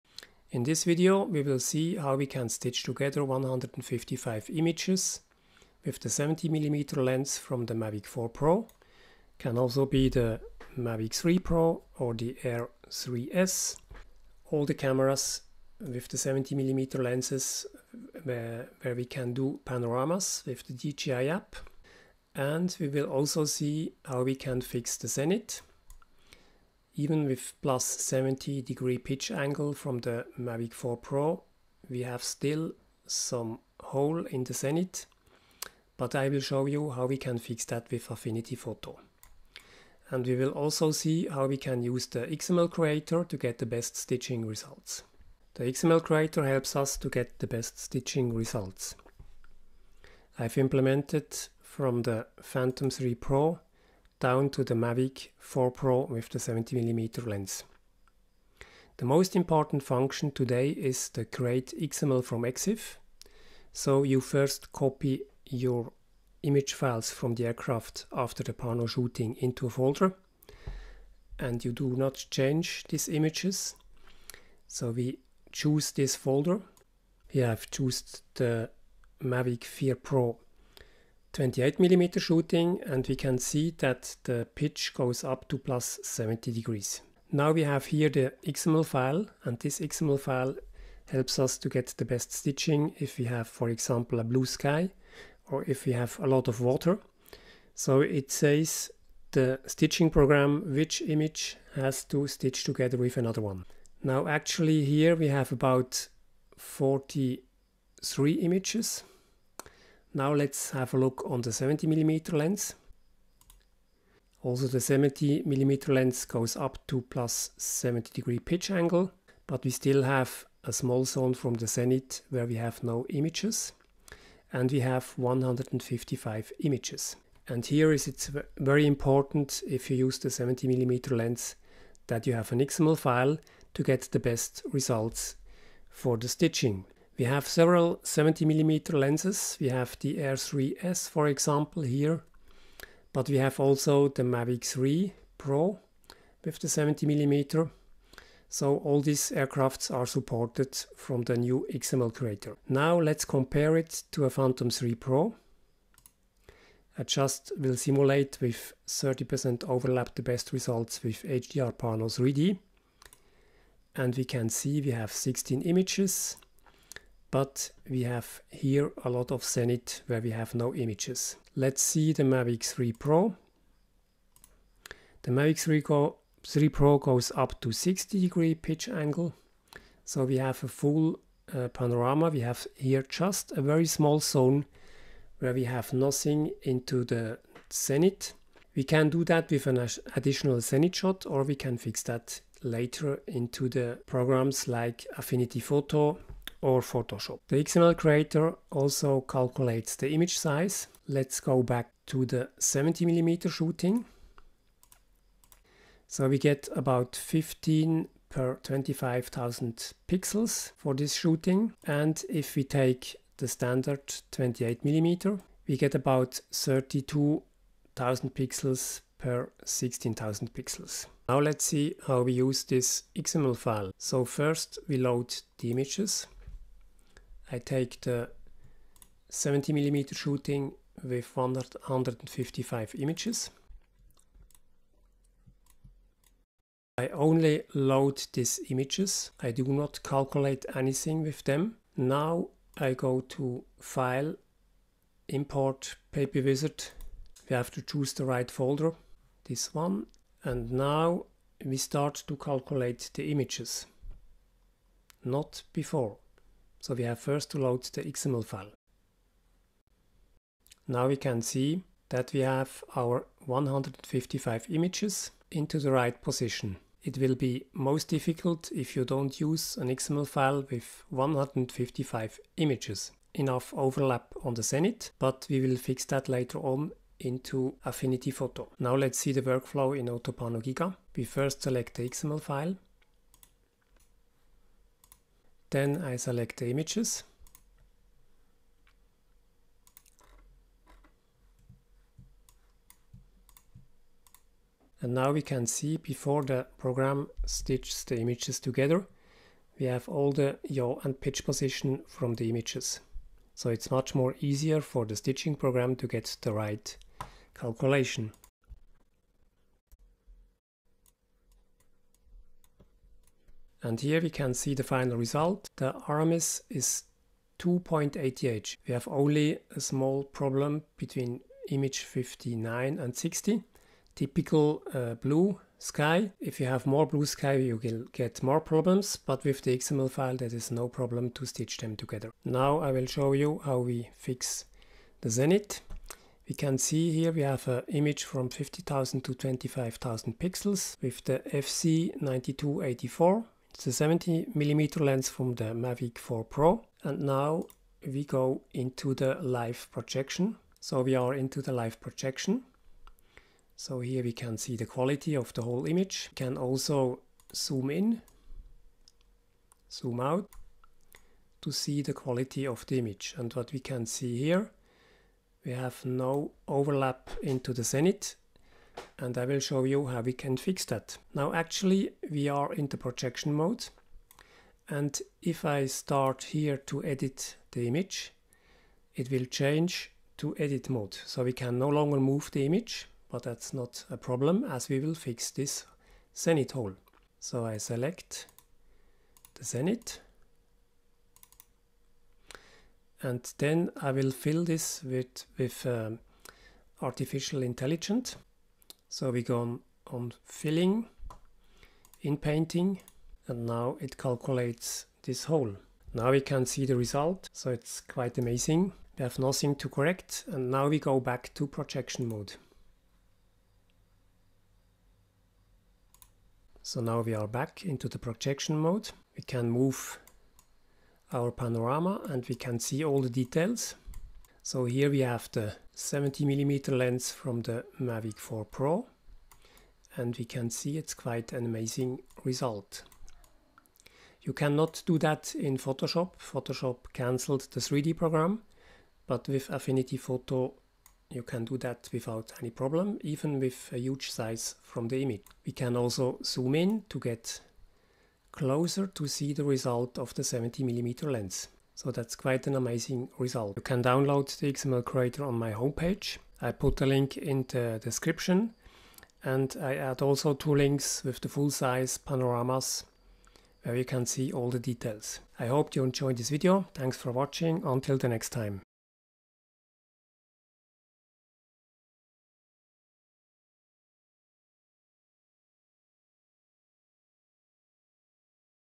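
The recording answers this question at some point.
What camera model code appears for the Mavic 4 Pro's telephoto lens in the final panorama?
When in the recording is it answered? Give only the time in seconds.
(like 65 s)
341 s.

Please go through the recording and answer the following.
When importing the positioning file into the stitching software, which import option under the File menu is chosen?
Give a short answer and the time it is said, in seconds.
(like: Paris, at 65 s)
Papywizard, at 246 s.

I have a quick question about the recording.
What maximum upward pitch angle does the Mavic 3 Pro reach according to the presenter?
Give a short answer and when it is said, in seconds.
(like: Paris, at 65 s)
60 degrees, at 177 s.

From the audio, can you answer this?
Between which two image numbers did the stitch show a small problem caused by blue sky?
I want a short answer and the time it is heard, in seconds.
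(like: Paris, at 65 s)
59 and 60, at 321 s.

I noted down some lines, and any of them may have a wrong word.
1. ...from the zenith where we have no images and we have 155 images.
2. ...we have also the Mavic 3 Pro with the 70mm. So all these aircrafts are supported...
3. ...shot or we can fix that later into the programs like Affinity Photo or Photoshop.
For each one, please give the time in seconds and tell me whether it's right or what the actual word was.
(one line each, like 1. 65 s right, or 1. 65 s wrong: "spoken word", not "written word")
1. 121 s right
2. 143 s right
3. 190 s right.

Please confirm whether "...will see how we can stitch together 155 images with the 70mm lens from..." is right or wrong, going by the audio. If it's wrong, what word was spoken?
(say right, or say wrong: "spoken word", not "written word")
right.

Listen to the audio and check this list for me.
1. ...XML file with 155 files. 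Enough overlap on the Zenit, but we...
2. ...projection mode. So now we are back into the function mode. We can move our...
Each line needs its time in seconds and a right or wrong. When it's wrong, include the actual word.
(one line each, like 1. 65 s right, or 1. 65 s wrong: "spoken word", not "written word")
1. 269 s wrong: "images", not "files"
2. 411 s wrong: "projection", not "function".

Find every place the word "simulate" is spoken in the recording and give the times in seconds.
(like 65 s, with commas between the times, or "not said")
157 s.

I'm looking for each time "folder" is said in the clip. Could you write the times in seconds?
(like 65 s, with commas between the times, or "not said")
69 s, 76 s, 248 s.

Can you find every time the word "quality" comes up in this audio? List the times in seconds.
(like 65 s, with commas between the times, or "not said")
354 s, 362 s.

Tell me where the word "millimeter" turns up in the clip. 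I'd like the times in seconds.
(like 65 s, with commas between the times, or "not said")
81 s, 203 s, 214 s, 229 s.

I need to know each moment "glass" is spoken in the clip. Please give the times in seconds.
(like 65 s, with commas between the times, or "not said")
not said.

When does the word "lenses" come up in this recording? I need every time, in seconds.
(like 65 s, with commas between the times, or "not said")
17 s, 138 s.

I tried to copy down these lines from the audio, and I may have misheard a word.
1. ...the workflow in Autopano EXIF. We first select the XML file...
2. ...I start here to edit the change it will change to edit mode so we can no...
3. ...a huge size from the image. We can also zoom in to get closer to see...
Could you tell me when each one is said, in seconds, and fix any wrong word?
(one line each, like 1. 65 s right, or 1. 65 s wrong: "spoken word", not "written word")
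1. 279 s wrong: "Giga", not "EXIF"
2. 375 s wrong: "image", not "change"
3. 443 s right.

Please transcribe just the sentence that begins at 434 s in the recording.
You cannot do that in Photoshop.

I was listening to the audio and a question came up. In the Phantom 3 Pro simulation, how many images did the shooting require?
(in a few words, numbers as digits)
16.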